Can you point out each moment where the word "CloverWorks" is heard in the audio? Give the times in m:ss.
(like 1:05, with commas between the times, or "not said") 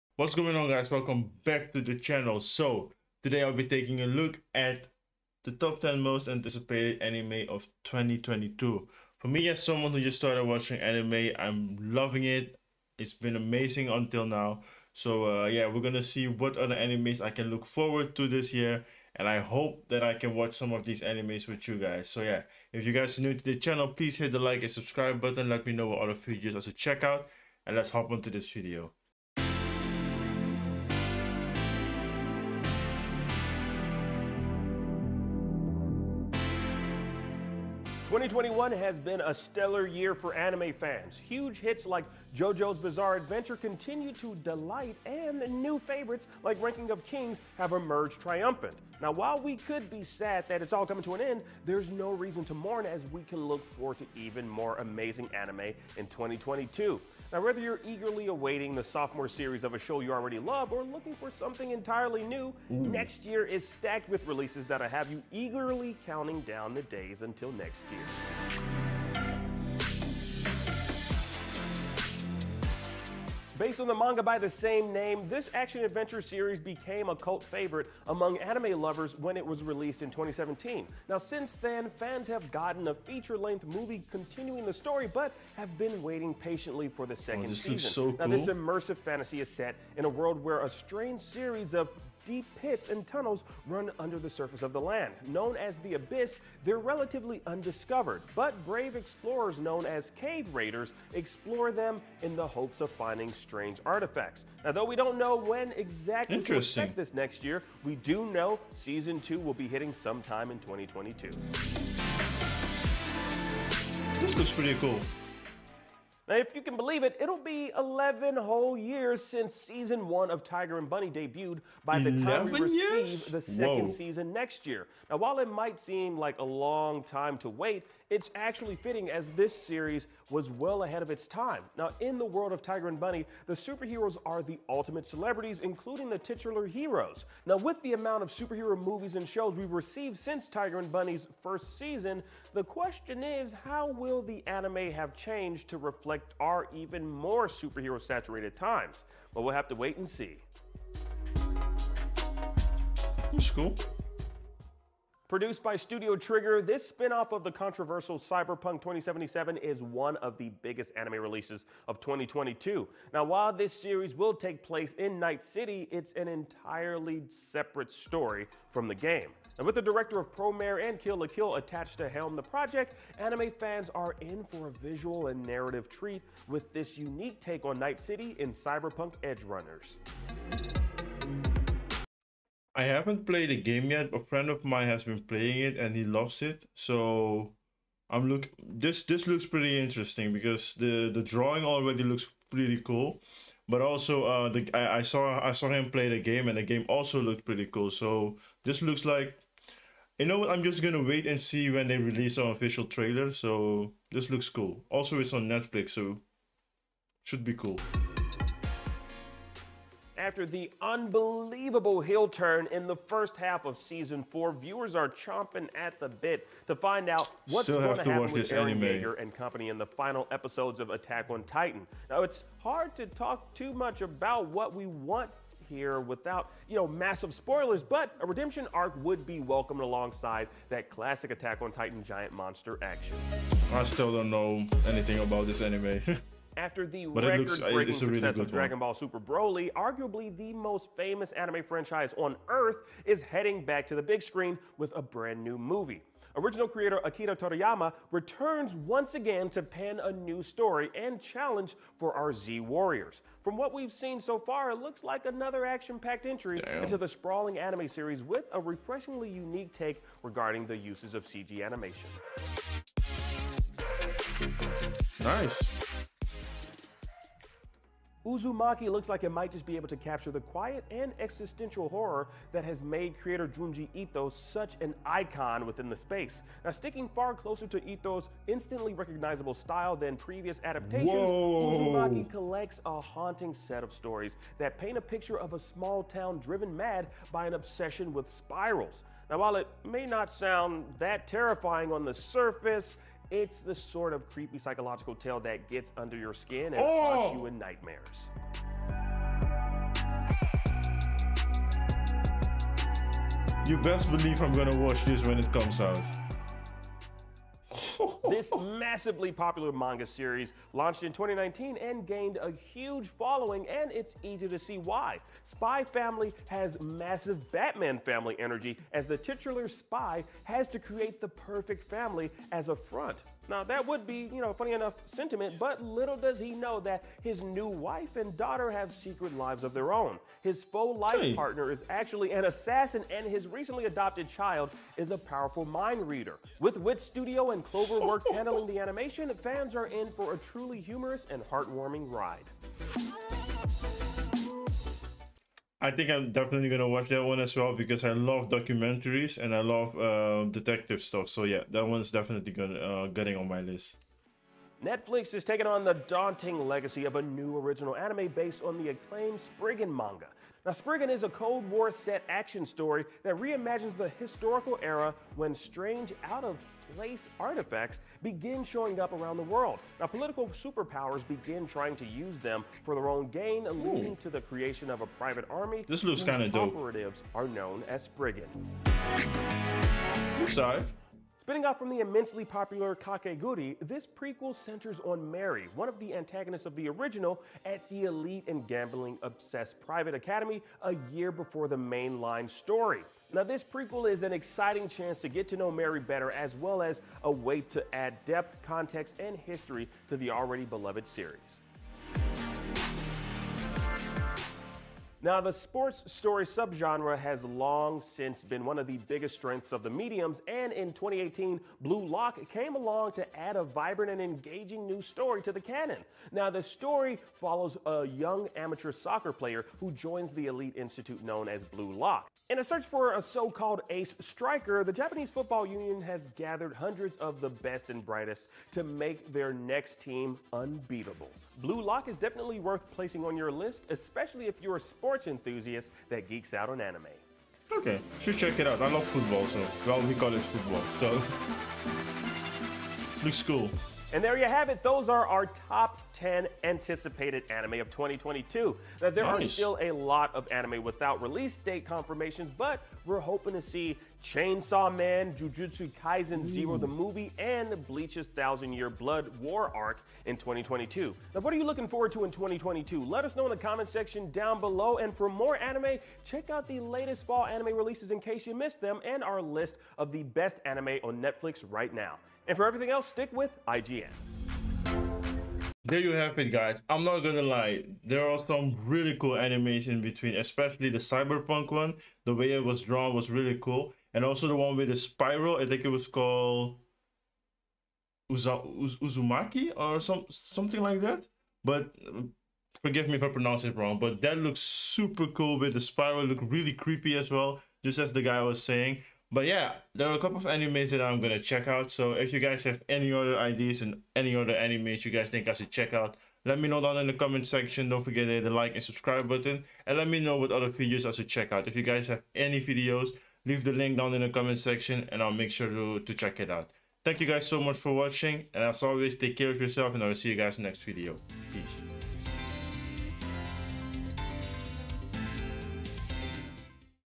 5:37.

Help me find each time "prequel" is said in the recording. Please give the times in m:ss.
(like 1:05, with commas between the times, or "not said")
6:24, 6:33.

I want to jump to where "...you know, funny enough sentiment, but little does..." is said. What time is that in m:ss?
5:24.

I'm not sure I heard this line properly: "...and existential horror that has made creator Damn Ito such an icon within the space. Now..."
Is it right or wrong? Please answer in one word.
wrong.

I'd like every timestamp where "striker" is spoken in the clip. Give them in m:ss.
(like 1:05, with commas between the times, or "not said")
7:04.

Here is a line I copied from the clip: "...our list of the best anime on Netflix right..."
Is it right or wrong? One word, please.
right.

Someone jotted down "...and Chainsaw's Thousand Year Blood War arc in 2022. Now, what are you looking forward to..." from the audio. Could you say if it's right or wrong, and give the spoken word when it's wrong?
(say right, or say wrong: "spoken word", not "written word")
wrong: "Bleach", not "Chainsaw".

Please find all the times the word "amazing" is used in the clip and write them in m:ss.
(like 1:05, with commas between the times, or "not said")
0:13, 0:54.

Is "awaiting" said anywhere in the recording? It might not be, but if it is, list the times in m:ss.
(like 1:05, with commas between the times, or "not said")
0:58.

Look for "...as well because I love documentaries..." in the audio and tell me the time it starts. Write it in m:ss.
5:47.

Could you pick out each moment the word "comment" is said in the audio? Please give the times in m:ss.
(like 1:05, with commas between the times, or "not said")
7:43, 8:27, 8:34.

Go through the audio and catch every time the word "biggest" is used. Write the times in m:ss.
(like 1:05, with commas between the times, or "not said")
2:40, 6:48.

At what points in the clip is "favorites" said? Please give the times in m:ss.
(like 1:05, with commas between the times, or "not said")
0:45, 1:17.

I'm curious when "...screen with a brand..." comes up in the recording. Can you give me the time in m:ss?
4:04.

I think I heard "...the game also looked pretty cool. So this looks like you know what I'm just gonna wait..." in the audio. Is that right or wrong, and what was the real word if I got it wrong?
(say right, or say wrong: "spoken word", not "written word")
right.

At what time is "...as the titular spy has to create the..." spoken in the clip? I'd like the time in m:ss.
5:18.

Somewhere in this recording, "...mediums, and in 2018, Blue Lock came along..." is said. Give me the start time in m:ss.
6:49.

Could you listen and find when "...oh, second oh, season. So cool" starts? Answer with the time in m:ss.
1:27.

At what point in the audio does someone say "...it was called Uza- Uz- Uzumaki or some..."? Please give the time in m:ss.
8:05.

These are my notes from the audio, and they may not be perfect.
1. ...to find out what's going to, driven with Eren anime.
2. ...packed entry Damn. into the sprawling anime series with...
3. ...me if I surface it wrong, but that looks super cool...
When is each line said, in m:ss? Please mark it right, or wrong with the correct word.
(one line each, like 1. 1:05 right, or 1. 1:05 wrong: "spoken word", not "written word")
1. 3:36 wrong: "happen", not "driven"
2. 4:15 right
3. 8:13 wrong: "pronounce", not "surface".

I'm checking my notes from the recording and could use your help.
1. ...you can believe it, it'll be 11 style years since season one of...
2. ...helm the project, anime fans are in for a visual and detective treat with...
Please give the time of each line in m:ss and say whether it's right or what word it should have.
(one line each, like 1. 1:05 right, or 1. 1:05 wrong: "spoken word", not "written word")
1. 1:56 wrong: "whole", not "style"
2. 2:52 wrong: "narrative", not "detective".